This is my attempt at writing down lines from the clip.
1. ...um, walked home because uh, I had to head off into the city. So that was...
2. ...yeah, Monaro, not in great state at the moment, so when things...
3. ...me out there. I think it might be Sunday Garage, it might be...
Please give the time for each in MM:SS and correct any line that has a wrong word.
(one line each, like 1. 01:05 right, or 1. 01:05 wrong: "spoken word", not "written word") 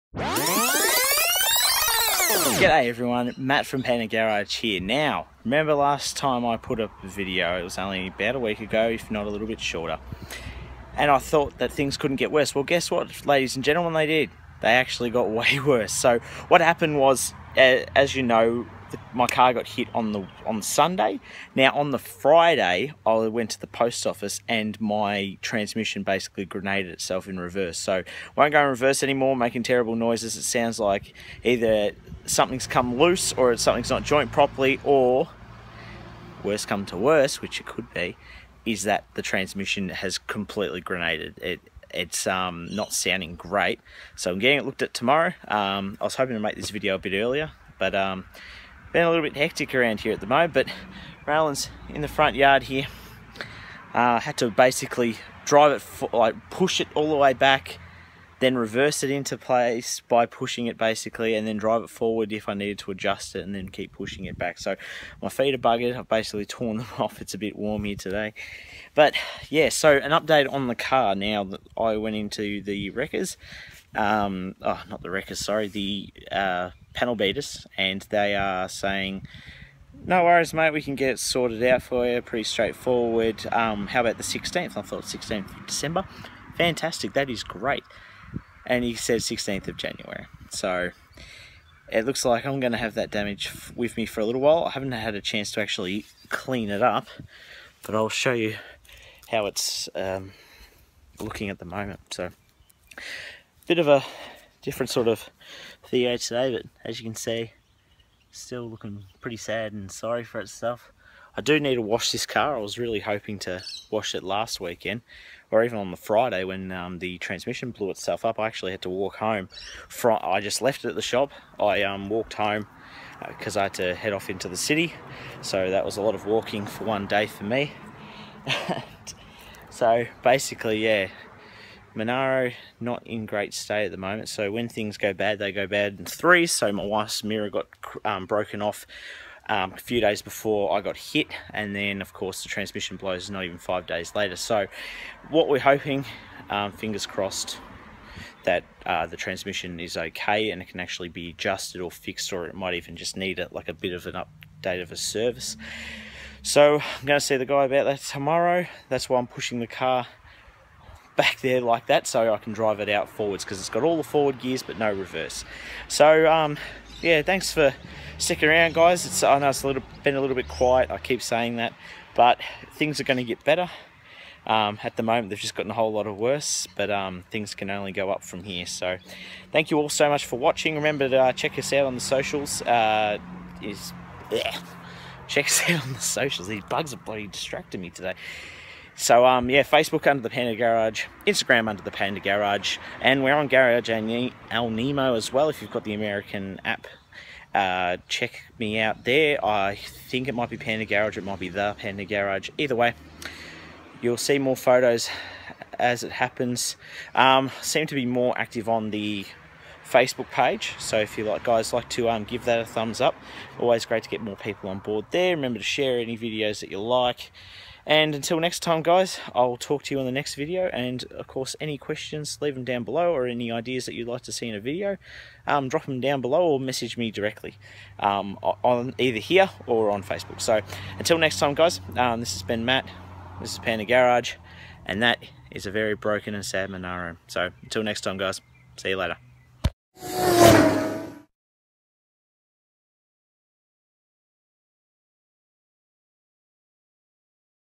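1. 02:01 right
2. 02:10 right
3. 03:18 wrong: "Panda", not "Sunday".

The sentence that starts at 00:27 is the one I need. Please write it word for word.
So won't go in reverse anymore, making terrible noises.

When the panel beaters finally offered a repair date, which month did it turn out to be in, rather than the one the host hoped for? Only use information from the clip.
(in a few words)
January.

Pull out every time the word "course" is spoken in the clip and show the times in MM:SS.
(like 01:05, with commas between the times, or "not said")
02:22, 03:41.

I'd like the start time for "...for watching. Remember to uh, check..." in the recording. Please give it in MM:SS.
03:00.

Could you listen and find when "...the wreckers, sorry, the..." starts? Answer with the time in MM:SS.
01:15.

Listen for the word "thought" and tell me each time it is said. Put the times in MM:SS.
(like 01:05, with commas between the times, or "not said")
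00:11, 01:24.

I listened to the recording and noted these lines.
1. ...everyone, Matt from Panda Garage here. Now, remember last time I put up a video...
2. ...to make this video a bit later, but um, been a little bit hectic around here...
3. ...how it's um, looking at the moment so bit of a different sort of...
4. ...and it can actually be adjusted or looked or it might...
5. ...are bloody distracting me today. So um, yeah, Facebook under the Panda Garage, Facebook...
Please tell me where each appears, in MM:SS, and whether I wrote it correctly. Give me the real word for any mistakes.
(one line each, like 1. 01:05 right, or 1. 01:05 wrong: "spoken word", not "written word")
1. 00:02 right
2. 00:46 wrong: "earlier", not "later"
3. 01:39 right
4. 02:30 wrong: "fixed", not "looked"
5. 03:06 wrong: "Instagram", not "Facebook".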